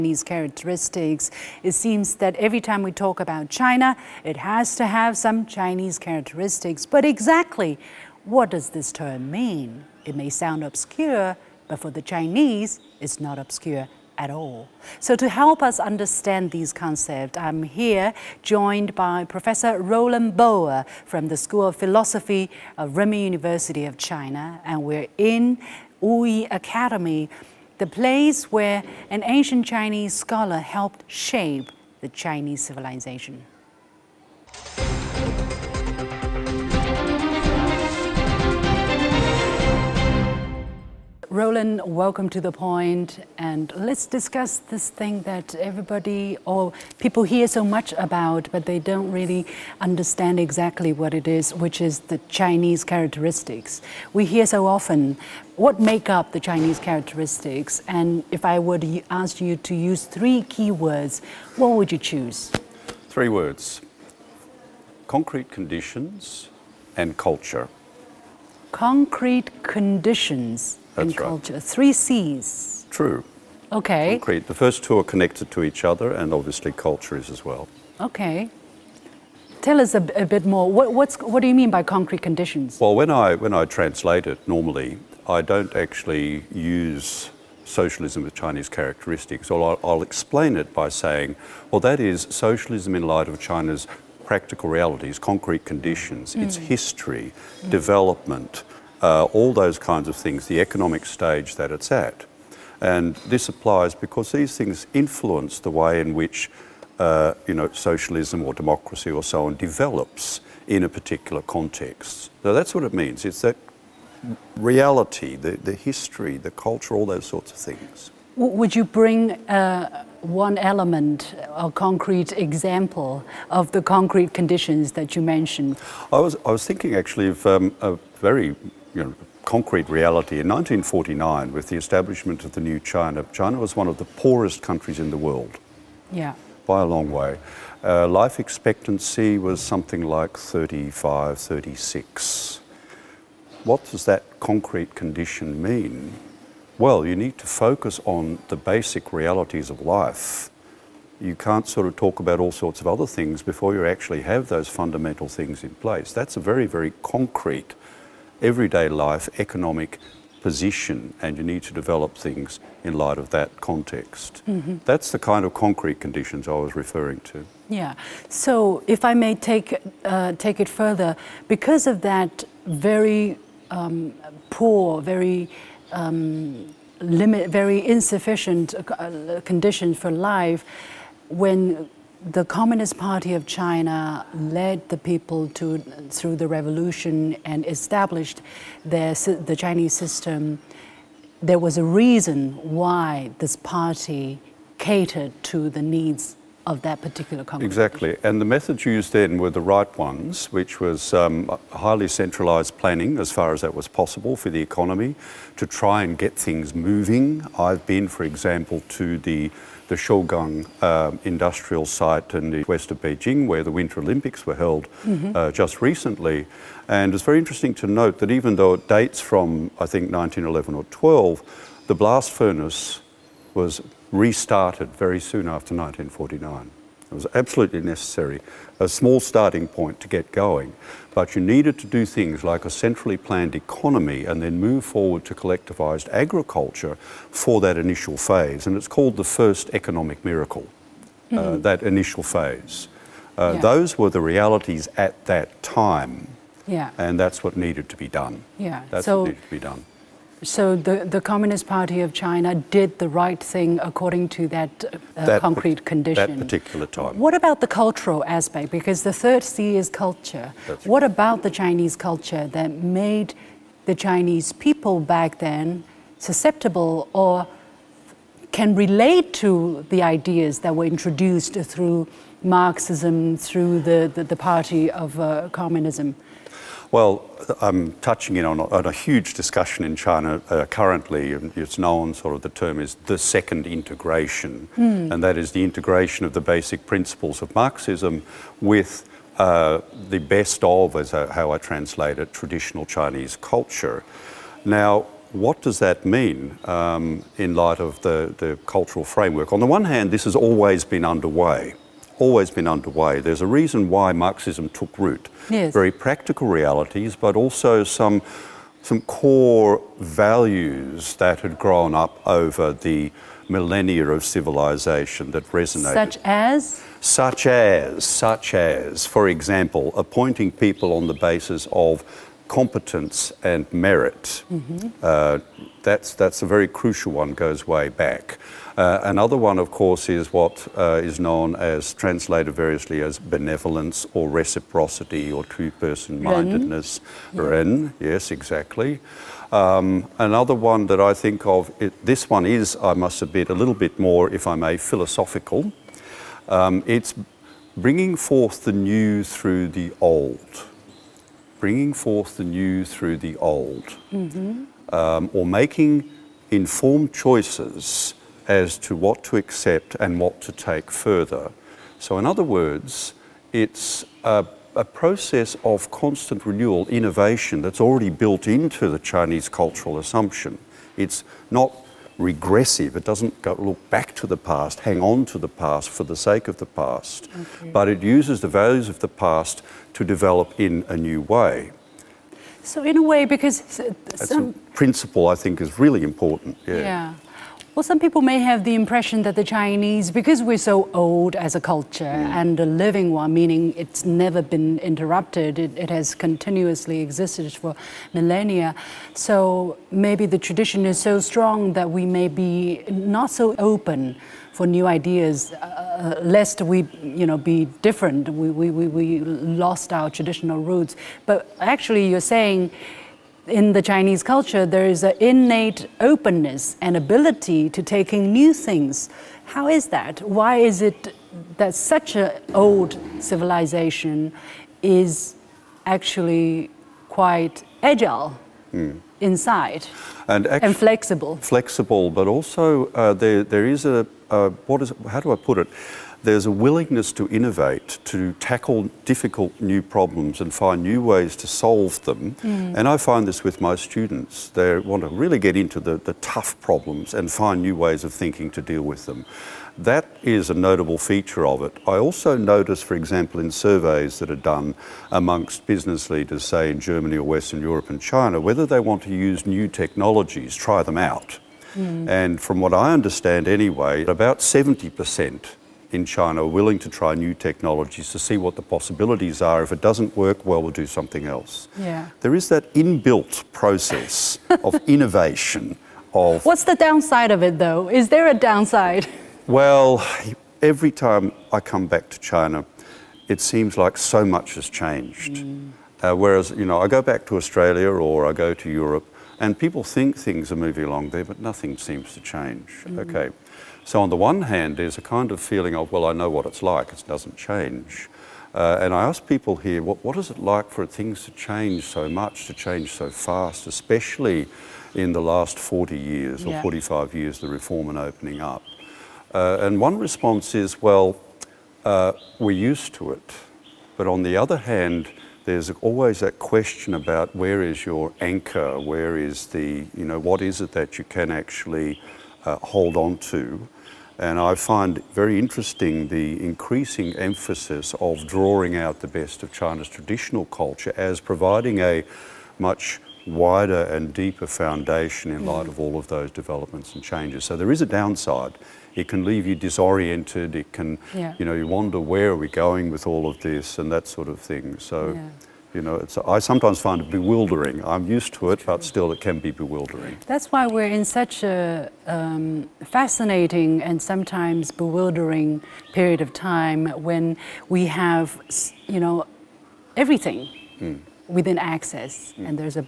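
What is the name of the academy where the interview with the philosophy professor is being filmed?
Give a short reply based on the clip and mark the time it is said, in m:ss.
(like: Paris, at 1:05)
Wuyi Academy, at 0:26.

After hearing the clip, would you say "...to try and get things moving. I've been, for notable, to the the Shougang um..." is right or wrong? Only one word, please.
wrong.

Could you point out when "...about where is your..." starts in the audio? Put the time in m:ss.
8:36.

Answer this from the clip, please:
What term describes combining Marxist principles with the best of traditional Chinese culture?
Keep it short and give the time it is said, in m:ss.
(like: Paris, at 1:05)
second integration, at 4:43.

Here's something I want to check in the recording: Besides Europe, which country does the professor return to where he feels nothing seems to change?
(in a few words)
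Australia.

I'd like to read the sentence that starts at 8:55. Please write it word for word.
light of all of those developments and changes.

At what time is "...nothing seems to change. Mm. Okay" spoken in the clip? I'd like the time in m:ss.
8:11.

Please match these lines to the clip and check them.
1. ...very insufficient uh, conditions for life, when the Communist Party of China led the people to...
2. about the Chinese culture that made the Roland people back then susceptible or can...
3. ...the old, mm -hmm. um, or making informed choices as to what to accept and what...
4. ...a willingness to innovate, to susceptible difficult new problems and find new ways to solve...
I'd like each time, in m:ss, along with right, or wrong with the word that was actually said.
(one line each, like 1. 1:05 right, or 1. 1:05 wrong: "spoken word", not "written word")
1. 2:57 right
2. 4:21 wrong: "Chinese", not "Roland"
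3. 5:53 right
4. 7:16 wrong: "tackle", not "susceptible".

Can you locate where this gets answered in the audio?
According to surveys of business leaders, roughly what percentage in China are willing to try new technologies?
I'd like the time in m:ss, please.
7:44.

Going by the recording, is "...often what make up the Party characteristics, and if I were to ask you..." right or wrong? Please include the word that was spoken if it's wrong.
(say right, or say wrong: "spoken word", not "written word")
wrong: "Chinese", not "Party".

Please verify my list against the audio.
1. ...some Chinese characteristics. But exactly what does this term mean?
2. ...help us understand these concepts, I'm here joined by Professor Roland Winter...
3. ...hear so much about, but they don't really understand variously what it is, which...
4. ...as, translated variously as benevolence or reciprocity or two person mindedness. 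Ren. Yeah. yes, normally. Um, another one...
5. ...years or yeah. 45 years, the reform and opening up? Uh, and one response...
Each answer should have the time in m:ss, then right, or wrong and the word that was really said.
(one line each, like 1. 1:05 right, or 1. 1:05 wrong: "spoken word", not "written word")
1. 0:05 right
2. 0:15 wrong: "Boer", not "Winter"
3. 0:47 wrong: "exactly", not "variously"
4. 5:31 wrong: "exactly", not "normally"
5. 8:25 right.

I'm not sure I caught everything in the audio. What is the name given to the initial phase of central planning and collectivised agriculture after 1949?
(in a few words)
first economic miracle.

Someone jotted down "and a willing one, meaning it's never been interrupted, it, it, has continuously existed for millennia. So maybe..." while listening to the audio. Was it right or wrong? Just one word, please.
wrong.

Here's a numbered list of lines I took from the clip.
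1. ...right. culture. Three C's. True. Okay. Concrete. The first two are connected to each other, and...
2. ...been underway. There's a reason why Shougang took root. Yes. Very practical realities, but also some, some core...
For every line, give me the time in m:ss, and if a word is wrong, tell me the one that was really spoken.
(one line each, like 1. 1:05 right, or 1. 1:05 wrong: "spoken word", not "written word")
1. 1:11 right
2. 5:02 wrong: "Marxism", not "Shougang".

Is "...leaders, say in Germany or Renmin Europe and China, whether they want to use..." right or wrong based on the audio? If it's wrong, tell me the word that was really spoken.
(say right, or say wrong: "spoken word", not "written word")
wrong: "Western", not "Renmin".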